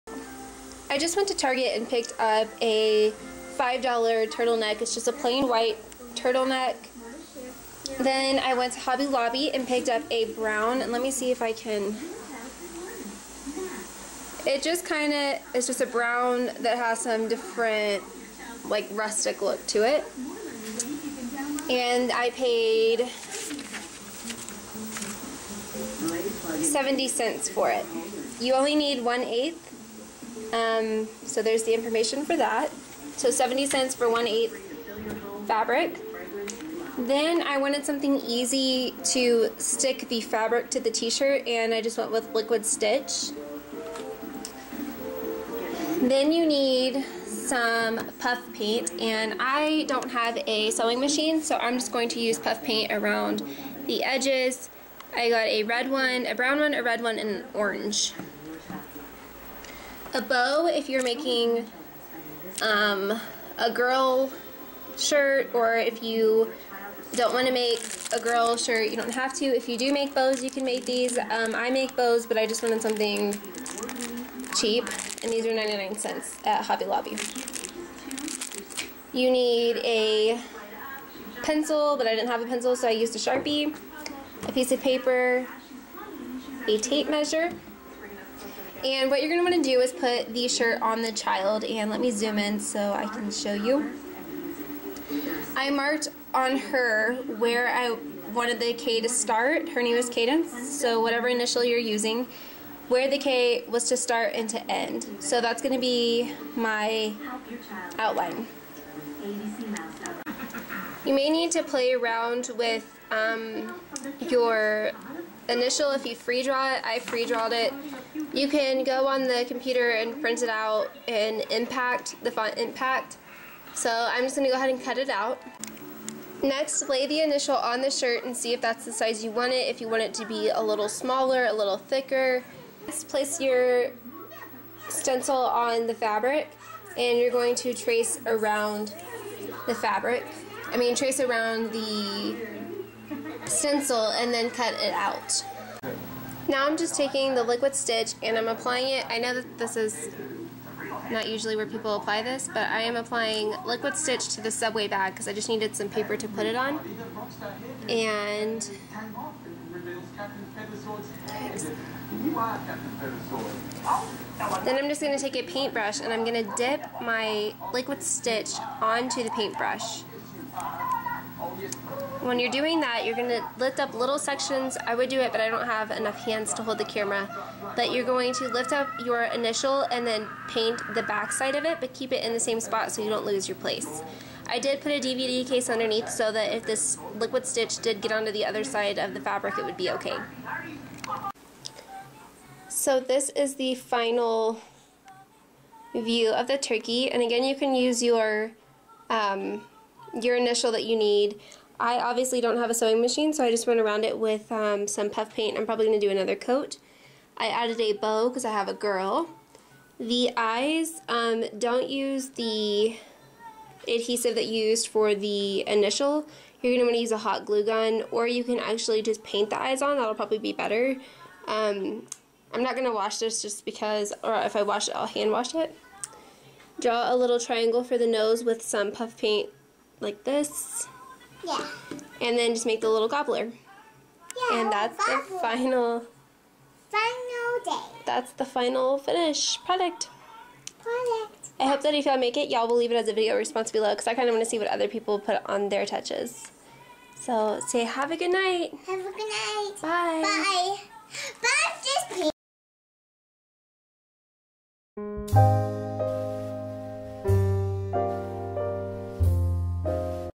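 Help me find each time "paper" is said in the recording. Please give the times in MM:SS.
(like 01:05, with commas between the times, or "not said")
01:24, 02:35.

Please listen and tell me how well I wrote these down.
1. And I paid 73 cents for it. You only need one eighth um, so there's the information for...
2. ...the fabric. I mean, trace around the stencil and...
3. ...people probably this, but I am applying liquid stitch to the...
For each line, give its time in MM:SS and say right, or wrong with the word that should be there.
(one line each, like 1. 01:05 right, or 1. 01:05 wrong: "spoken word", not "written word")
1. 00:21 wrong: "70", not "73"
2. 02:19 right
3. 02:31 wrong: "apply", not "probably".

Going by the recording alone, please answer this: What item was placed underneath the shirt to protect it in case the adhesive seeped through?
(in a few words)
A DVD case.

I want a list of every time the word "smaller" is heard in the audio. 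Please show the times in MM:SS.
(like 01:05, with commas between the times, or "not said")
02:10.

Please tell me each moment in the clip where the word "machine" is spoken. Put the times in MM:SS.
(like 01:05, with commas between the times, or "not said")
00:50, 03:23.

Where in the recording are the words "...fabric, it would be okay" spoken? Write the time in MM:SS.
03:09.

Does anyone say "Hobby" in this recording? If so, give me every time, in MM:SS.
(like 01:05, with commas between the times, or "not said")
00:08, 01:16.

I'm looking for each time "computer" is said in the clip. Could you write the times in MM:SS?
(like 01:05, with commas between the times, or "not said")
01:59.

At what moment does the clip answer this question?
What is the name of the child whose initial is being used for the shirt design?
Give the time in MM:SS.
01:40.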